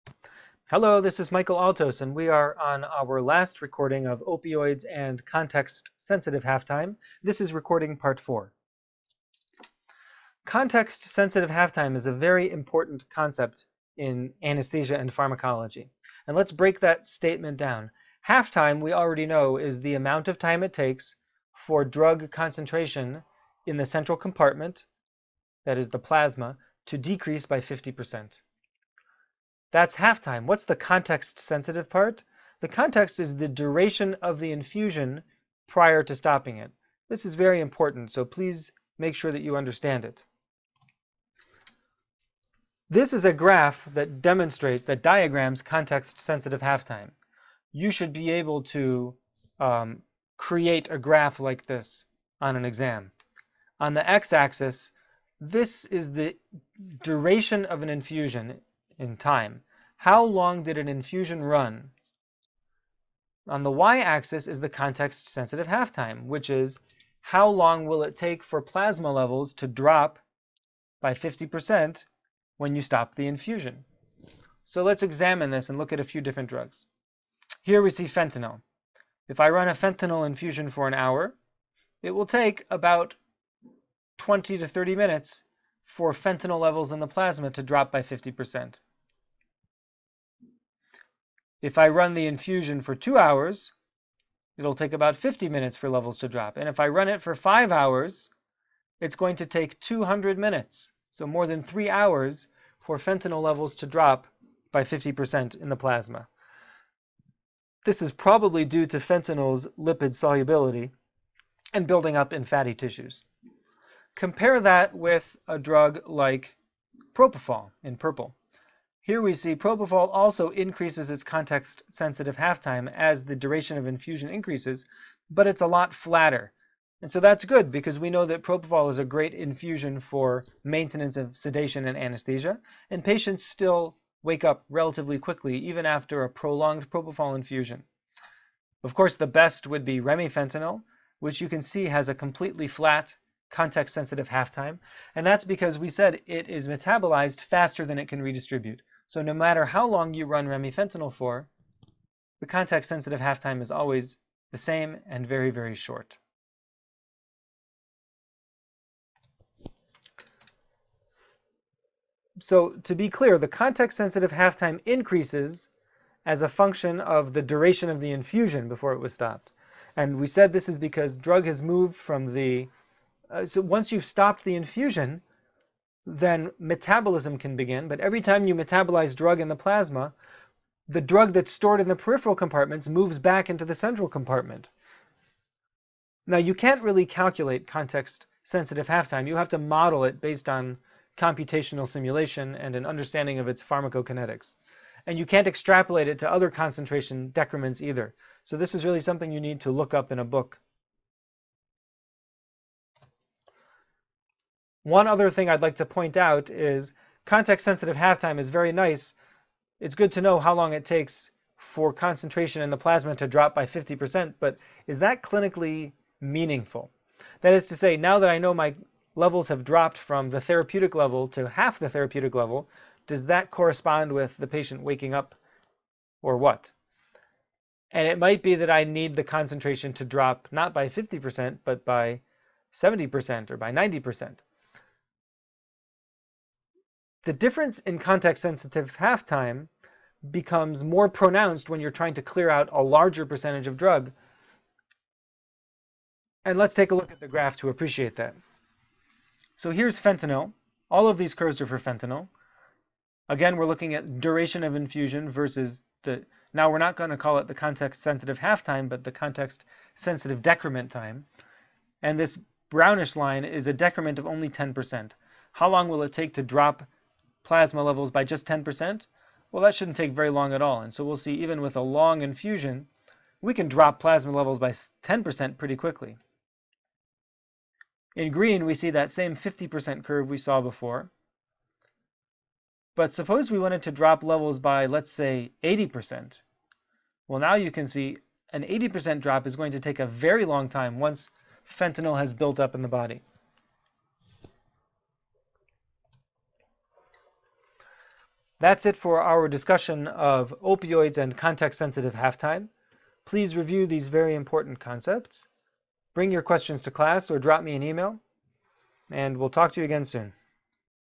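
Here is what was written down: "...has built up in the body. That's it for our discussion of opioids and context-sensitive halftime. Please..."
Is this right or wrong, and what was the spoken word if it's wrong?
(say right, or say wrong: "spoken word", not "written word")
right.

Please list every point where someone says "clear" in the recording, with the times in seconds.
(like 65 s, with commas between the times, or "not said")
163 s, 242 s.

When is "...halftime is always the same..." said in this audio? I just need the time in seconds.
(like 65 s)
153 s.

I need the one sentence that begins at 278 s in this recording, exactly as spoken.
In green, we see that same 50% curve we saw before.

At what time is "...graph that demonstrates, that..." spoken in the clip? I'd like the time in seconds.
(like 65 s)
43 s.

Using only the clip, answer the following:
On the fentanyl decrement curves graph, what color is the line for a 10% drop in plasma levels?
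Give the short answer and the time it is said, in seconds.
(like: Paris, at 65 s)
Brownish, at 262 s.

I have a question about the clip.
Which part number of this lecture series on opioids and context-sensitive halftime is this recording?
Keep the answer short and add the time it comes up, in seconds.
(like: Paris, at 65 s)
4, at 8 s.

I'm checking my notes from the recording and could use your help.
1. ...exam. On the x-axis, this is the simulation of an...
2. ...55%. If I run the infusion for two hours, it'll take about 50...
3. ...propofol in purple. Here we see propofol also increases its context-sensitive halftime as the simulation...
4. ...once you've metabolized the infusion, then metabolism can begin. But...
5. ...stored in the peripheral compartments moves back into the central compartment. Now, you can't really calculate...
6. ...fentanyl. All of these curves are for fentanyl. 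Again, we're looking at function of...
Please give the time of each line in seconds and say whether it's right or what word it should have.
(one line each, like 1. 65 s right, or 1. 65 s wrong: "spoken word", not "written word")
1. 52 s wrong: "duration", not "simulation"
2. 88 s wrong: "50", not "55"
3. 117 s wrong: "duration", not "simulation"
4. 173 s wrong: "stopped", not "metabolized"
5. 181 s right
6. 249 s wrong: "duration", not "function".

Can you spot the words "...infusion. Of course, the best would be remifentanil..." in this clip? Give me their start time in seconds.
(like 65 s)
137 s.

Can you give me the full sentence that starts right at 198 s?
So, this is really something you need to look up in a book.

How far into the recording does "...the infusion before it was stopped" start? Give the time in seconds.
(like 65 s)
167 s.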